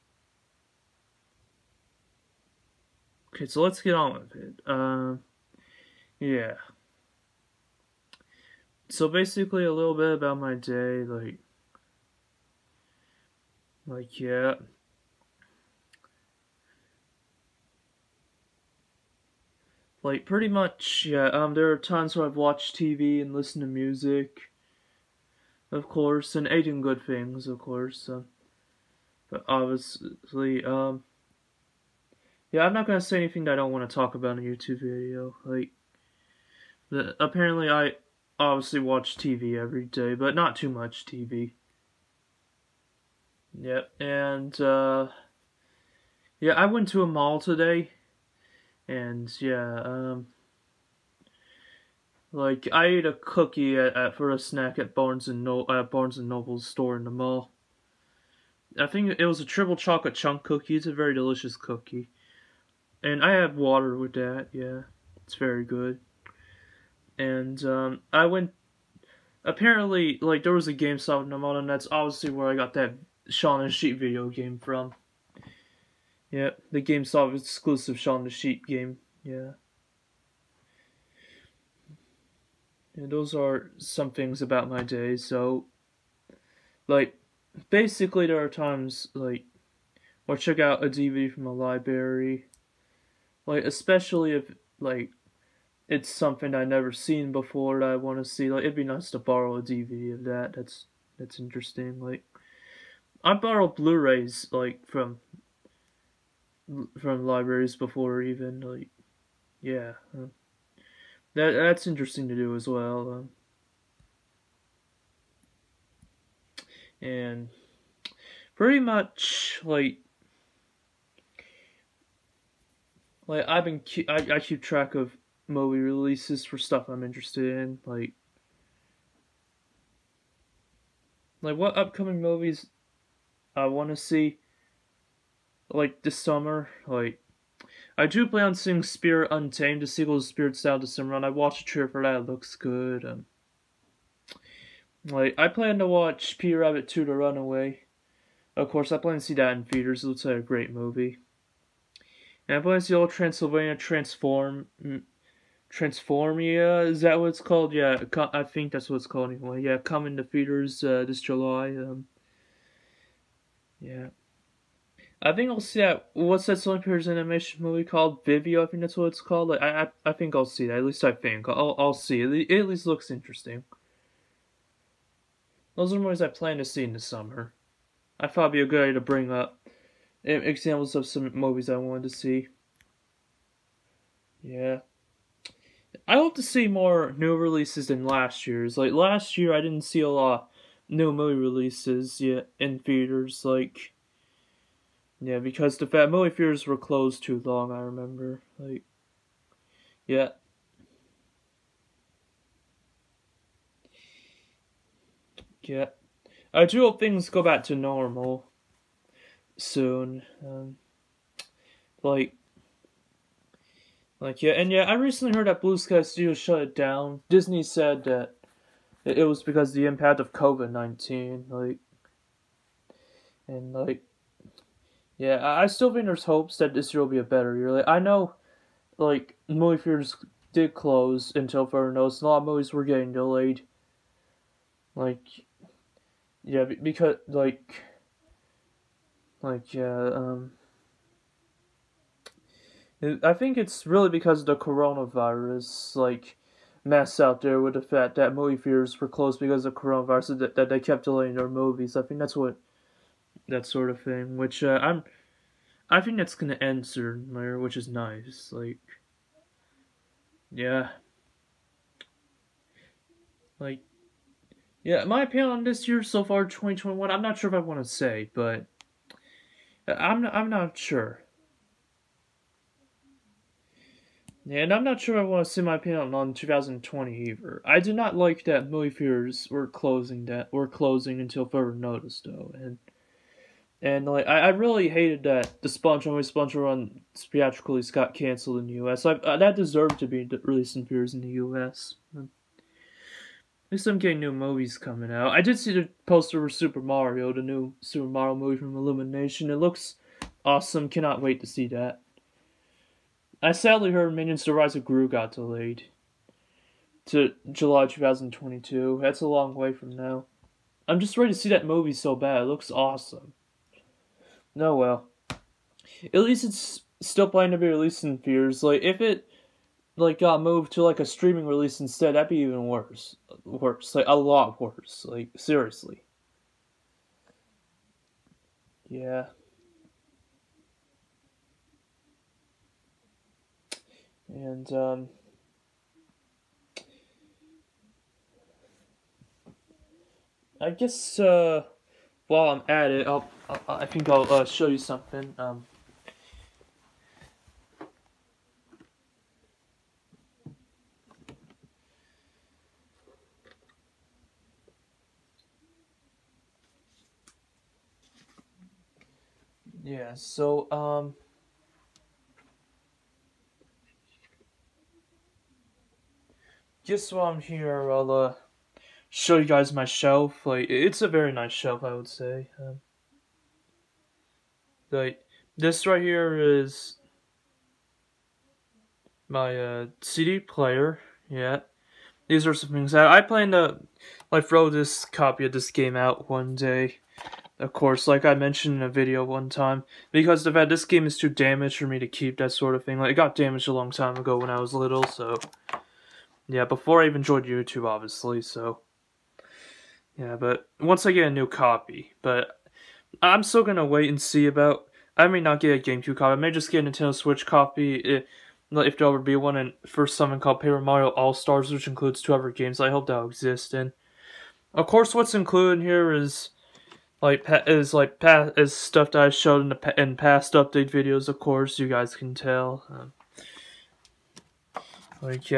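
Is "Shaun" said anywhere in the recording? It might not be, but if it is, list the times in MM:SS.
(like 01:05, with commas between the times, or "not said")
01:13, 01:17.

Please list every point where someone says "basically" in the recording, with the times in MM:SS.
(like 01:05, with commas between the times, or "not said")
00:09, 01:27.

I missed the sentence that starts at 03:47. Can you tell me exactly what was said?
Like, I know, like, movie theaters did close until further notice.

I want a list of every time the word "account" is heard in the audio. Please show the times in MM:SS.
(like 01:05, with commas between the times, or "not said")
not said.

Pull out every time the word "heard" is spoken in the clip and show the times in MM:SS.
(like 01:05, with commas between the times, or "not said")
03:35, 05:03.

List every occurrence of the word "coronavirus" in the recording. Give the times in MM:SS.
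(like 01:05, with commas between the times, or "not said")
04:04, 04:09.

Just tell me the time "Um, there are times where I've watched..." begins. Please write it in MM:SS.
00:21.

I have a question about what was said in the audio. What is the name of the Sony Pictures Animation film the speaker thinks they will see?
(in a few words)
Vivo.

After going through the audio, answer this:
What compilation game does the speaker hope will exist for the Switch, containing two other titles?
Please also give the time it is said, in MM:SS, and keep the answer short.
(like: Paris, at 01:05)
Paper Mario All Stars, at 06:50.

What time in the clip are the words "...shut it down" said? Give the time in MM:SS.
03:36.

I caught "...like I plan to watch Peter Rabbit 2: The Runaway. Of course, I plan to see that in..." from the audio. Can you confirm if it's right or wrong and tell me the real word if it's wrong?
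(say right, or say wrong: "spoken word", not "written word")
right.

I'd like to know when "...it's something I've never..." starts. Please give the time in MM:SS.
01:35.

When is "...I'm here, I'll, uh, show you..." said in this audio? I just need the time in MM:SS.
06:07.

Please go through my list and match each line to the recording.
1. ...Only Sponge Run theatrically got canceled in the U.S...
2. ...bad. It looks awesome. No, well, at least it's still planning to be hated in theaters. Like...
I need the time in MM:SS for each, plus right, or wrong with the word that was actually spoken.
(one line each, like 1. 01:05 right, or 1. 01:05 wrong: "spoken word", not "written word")
1. 04:46 right
2. 05:12 wrong: "released", not "hated".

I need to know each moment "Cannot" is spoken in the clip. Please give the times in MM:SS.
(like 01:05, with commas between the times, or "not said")
05:00.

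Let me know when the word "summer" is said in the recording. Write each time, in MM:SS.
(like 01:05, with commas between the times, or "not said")
02:16, 02:20, 02:56.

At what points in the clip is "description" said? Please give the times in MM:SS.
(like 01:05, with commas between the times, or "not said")
not said.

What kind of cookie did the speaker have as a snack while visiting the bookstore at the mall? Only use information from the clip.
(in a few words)
Triple chocolate chunk.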